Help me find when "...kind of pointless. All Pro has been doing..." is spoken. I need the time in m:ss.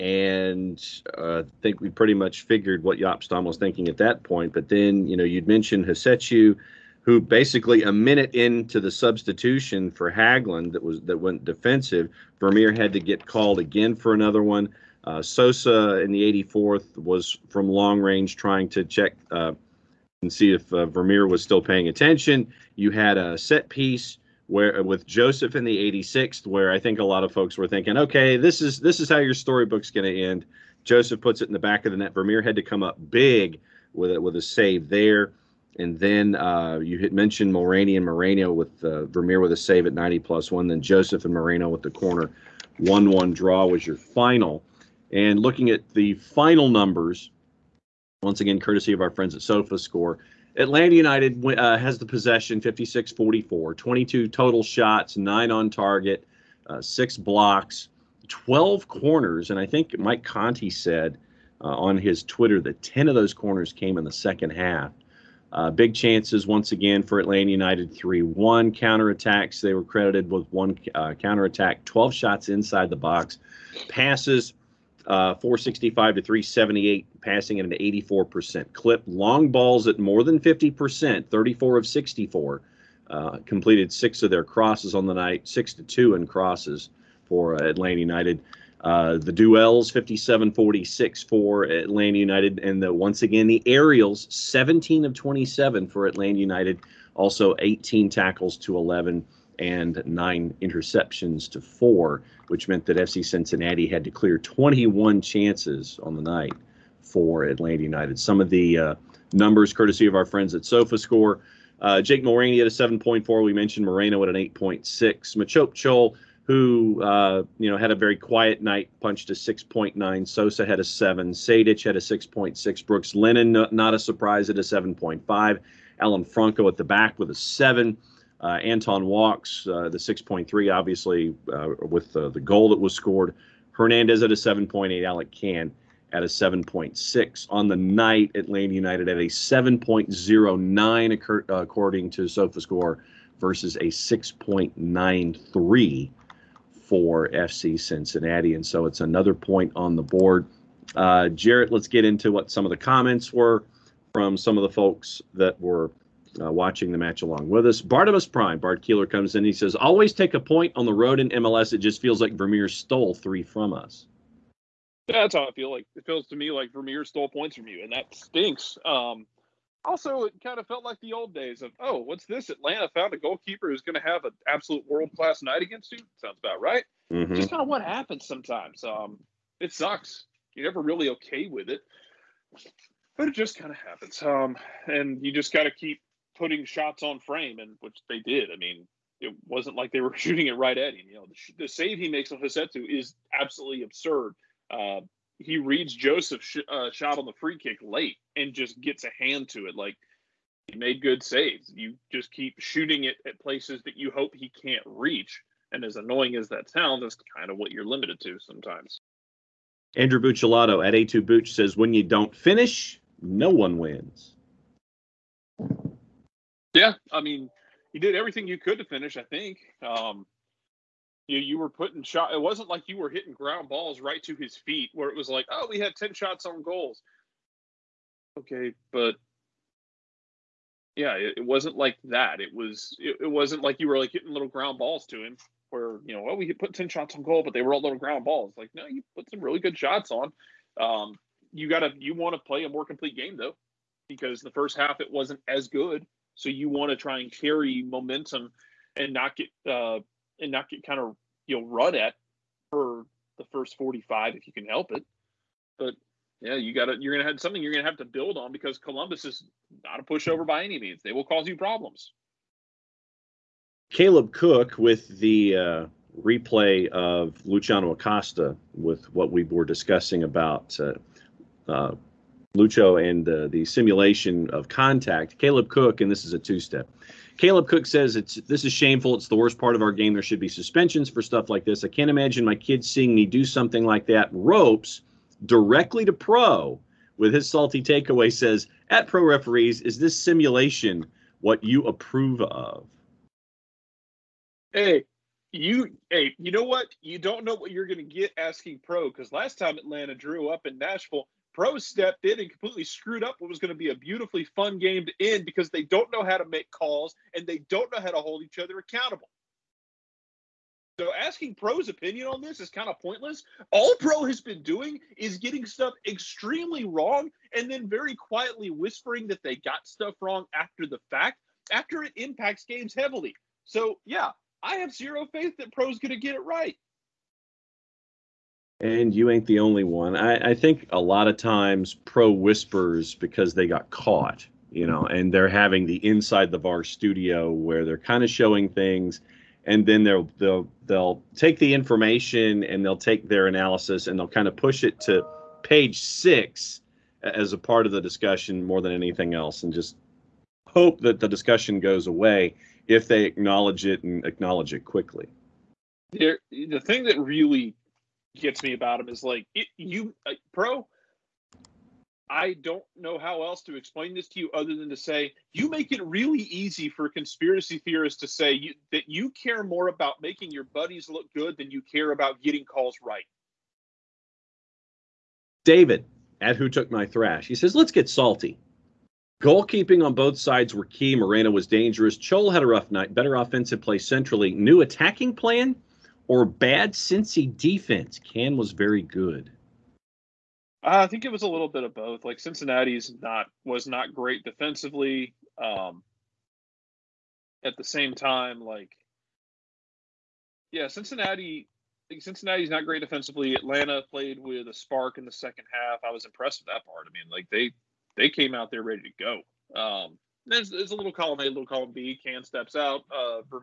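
5:12.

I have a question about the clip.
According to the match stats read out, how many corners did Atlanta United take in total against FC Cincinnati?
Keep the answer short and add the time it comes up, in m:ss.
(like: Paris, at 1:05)
12, at 0:58.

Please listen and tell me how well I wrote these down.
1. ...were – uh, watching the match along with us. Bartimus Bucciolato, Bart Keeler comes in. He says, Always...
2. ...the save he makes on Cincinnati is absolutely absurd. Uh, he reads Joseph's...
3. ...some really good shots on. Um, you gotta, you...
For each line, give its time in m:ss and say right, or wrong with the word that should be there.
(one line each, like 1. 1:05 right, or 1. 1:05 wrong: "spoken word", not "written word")
1. 2:35 wrong: "Prime", not "Bucciolato"
2. 3:11 wrong: "Rossetto", not "Cincinnati"
3. 3:59 right.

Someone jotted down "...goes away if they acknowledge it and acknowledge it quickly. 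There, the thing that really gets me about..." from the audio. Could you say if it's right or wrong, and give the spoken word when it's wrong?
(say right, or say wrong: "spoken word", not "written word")
right.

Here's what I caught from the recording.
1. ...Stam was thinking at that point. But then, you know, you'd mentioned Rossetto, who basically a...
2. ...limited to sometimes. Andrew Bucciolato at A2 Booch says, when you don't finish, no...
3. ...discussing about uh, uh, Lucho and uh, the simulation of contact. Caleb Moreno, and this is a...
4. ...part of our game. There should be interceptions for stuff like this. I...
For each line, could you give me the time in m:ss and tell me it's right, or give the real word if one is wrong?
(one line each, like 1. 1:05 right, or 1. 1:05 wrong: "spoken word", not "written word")
1. 0:03 right
2. 3:27 right
3. 4:29 wrong: "Cook", not "Moreno"
4. 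4:39 wrong: "suspensions", not "interceptions".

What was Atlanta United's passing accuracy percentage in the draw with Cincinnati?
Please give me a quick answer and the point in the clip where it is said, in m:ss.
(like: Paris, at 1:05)
84%, at 1:17.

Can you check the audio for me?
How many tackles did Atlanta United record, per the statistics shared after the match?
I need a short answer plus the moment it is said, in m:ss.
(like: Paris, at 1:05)
18, at 1:37.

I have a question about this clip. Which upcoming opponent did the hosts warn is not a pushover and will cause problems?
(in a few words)
Columbus.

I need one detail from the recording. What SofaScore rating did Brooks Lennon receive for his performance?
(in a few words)
7.5.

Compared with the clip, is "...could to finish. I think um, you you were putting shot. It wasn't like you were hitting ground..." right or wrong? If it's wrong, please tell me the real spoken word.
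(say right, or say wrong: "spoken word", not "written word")
right.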